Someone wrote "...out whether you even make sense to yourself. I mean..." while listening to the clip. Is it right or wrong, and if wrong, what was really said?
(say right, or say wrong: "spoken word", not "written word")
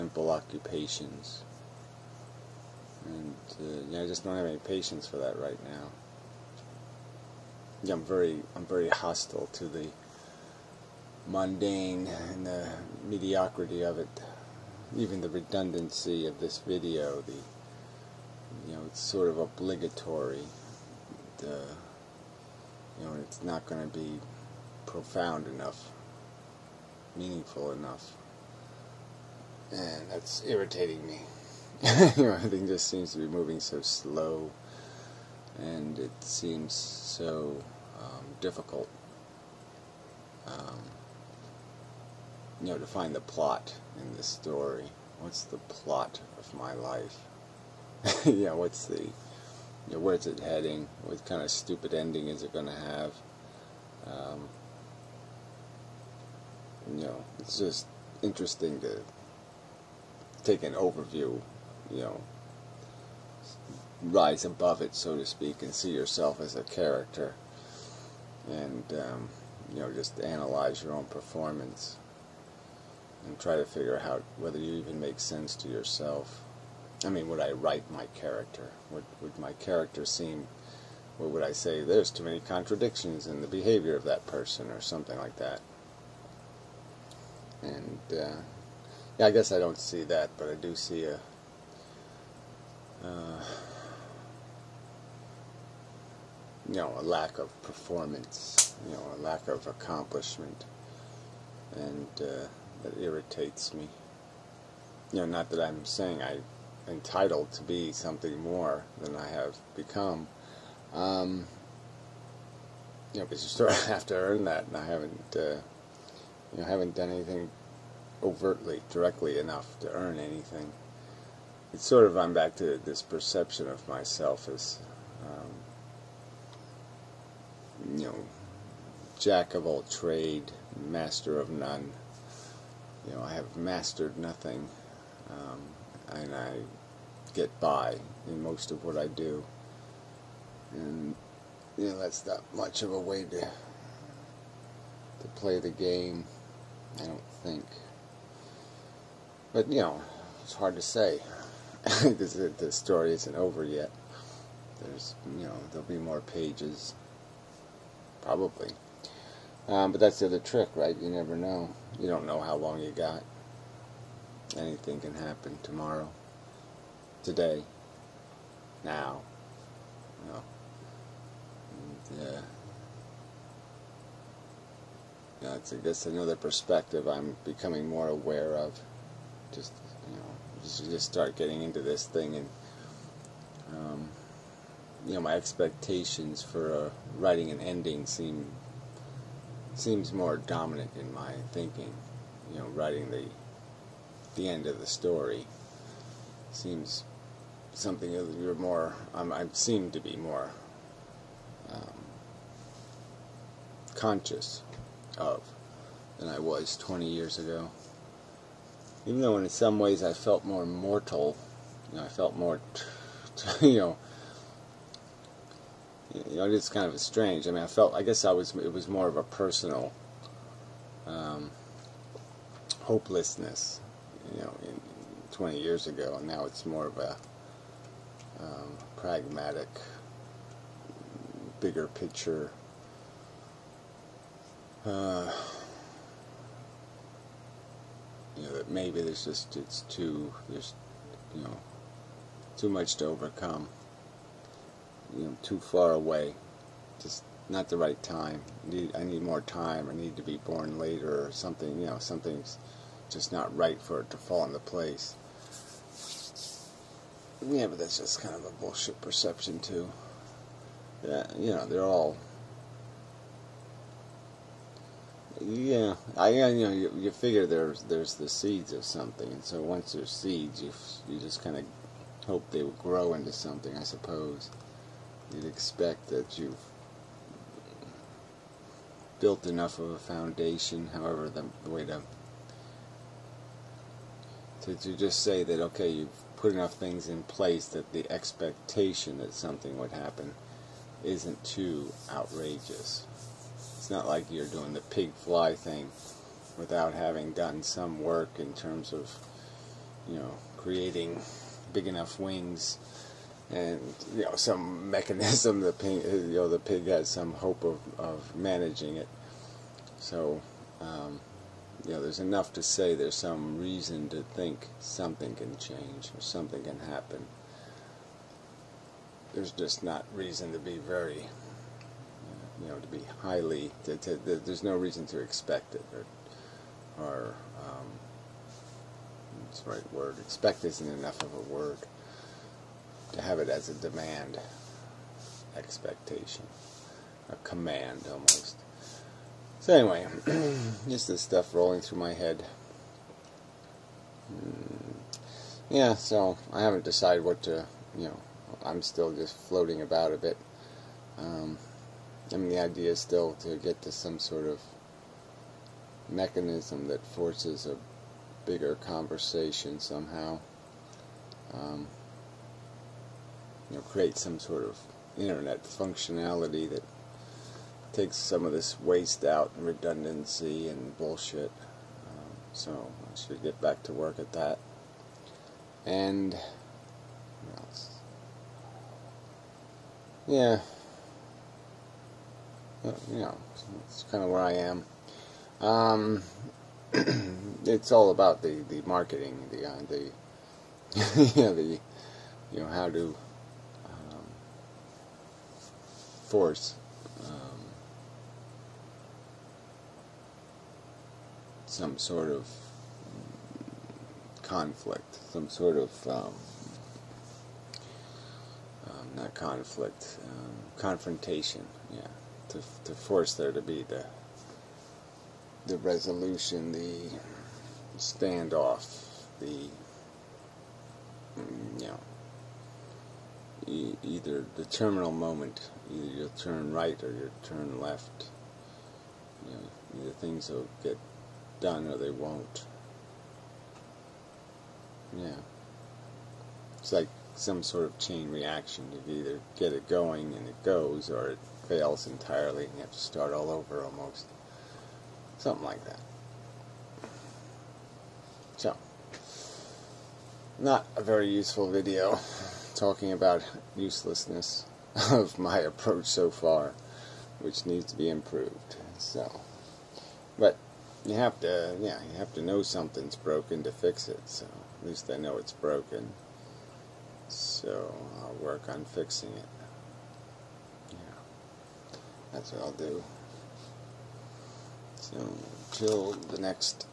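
right.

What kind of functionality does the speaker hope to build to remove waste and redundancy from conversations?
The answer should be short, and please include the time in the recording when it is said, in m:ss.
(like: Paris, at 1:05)
internet functionality, at 6:05.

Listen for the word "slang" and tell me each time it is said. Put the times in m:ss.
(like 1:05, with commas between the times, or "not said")
not said.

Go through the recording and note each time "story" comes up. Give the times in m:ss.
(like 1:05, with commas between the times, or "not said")
0:44, 2:32, 3:14.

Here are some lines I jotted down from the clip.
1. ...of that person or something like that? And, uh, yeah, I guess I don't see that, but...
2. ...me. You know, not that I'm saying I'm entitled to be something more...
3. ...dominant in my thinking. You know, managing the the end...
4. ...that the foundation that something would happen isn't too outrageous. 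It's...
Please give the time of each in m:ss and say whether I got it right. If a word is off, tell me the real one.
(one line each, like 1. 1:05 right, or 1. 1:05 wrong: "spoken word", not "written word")
1. 1:23 right
2. 1:43 right
3. 3:10 wrong: "writing", not "managing"
4. 4:47 wrong: "expectation", not "foundation".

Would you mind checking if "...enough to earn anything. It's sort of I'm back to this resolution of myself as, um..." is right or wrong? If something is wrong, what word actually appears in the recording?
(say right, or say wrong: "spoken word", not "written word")
wrong: "perception", not "resolution".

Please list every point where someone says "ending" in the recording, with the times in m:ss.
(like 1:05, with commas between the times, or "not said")
0:51, 3:07.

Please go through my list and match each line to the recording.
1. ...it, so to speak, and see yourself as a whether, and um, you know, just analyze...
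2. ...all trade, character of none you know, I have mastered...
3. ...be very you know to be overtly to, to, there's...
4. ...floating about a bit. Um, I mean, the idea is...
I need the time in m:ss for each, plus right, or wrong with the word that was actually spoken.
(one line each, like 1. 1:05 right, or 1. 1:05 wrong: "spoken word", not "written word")
1. 1:04 wrong: "character", not "whether"
2. 2:09 wrong: "master", not "character"
3. 5:20 wrong: "highly", not "overtly"
4. 5:49 right.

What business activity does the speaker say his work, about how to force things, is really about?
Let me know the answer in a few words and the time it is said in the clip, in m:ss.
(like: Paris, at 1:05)
marketing, at 6:28.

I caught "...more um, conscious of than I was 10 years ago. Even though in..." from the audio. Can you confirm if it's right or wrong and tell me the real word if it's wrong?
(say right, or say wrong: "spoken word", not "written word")
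wrong: "20", not "10".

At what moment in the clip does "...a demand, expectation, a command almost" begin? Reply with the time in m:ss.
5:33.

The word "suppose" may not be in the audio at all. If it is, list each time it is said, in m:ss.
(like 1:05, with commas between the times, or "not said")
4:33.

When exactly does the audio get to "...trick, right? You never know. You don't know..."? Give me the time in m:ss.
2:40.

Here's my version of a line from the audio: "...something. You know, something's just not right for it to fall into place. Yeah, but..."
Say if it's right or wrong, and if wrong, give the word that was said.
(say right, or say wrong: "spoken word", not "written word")
right.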